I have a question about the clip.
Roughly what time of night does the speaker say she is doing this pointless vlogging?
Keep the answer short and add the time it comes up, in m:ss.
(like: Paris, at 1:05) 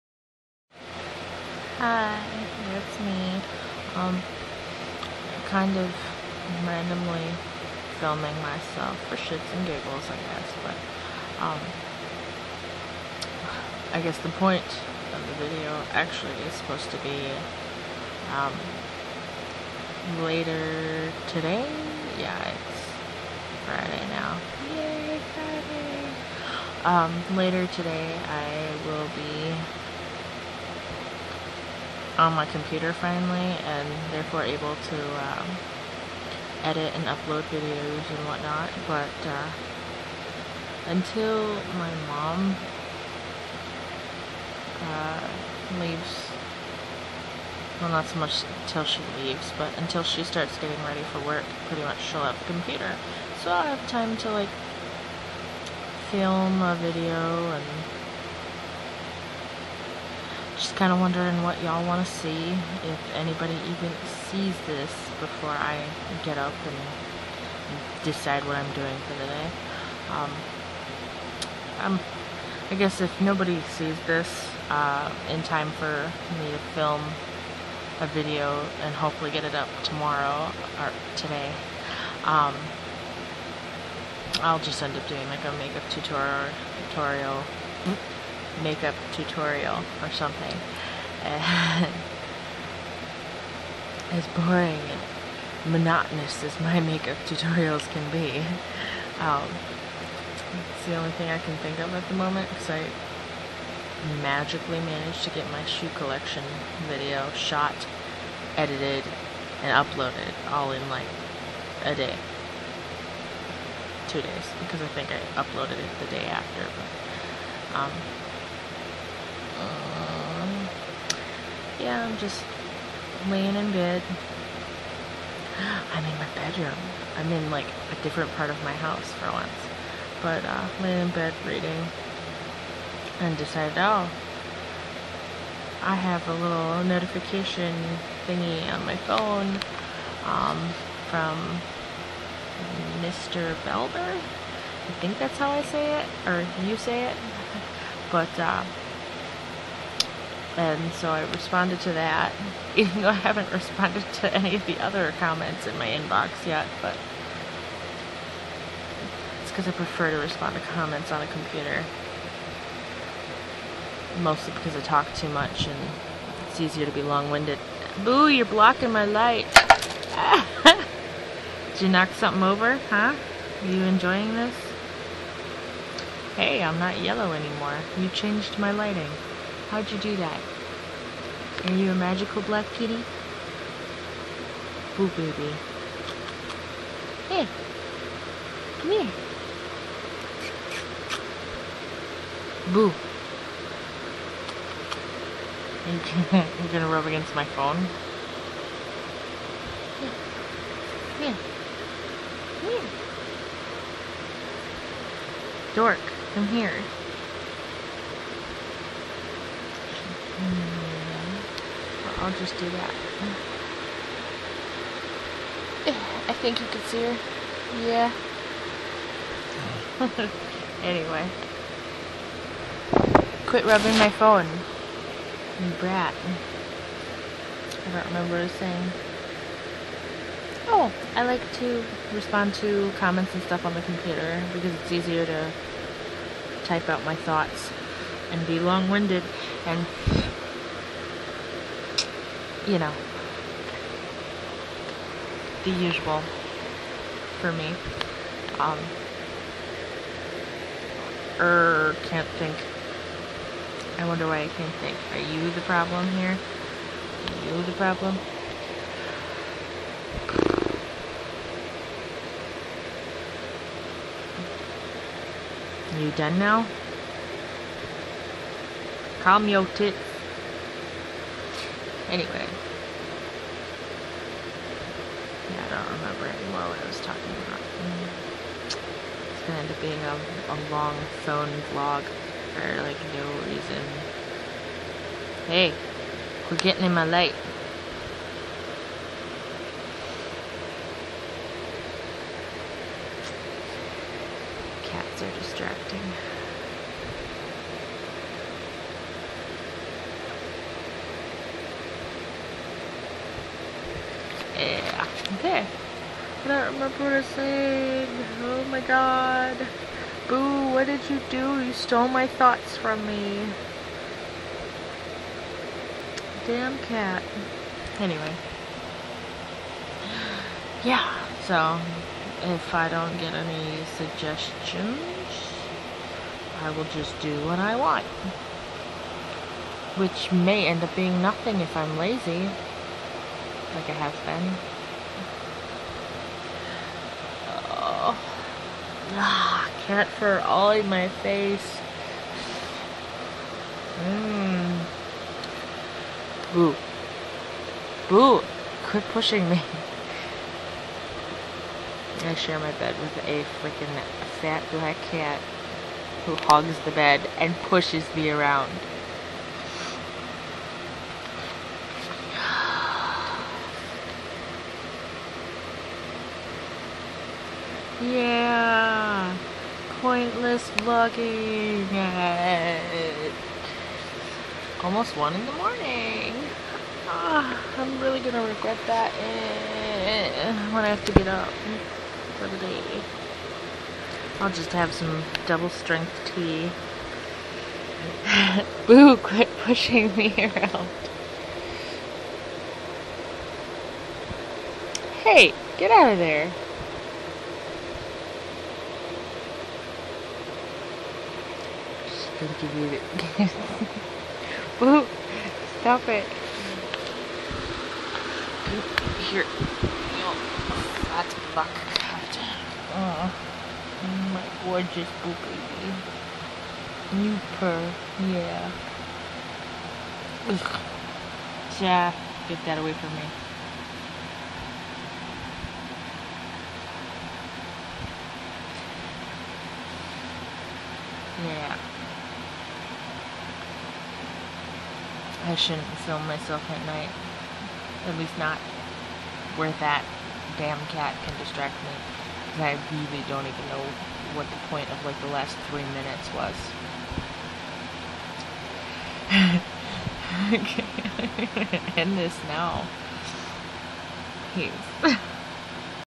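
1 in the morning, at 6:15.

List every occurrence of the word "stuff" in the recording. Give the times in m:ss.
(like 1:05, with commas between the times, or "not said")
3:53.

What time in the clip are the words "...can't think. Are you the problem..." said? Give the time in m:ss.
4:14.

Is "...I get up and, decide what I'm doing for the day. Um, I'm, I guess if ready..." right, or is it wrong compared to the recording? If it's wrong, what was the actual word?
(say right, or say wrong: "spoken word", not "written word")
wrong: "nobody", not "ready".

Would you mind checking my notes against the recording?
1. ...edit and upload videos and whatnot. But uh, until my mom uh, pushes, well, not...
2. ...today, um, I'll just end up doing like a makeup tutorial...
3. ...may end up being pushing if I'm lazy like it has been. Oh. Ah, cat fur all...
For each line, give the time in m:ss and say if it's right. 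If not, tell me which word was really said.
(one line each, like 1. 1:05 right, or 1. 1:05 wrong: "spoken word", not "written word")
1. 0:36 wrong: "leaves", not "pushes"
2. 1:21 right
3. 5:30 wrong: "nothing", not "pushing".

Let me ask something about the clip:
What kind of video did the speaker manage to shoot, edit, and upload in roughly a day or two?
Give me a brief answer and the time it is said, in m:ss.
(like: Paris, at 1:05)
shoe collection video, at 1:45.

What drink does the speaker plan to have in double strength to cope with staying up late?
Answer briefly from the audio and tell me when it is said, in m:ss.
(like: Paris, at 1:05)
tea, at 6:26.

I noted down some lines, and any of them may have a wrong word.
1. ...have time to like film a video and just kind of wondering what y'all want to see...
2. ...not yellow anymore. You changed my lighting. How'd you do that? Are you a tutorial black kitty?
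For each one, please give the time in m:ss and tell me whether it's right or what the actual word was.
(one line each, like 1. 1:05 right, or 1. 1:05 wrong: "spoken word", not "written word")
1. 0:53 right
2. 2:56 wrong: "magical", not "tutorial".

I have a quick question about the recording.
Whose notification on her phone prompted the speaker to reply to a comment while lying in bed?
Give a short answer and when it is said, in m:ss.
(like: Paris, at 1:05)
Mr. Belder, at 2:23.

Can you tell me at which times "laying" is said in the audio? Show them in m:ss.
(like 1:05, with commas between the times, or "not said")
2:03, 2:10.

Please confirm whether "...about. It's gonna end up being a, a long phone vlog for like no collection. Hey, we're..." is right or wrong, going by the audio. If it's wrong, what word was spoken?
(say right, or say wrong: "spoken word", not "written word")
wrong: "reason", not "collection".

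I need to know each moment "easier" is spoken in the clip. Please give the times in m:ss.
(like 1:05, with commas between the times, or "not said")
2:46, 3:54.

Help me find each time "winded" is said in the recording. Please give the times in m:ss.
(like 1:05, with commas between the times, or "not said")
2:47, 3:58.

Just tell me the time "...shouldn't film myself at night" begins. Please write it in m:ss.
7:15.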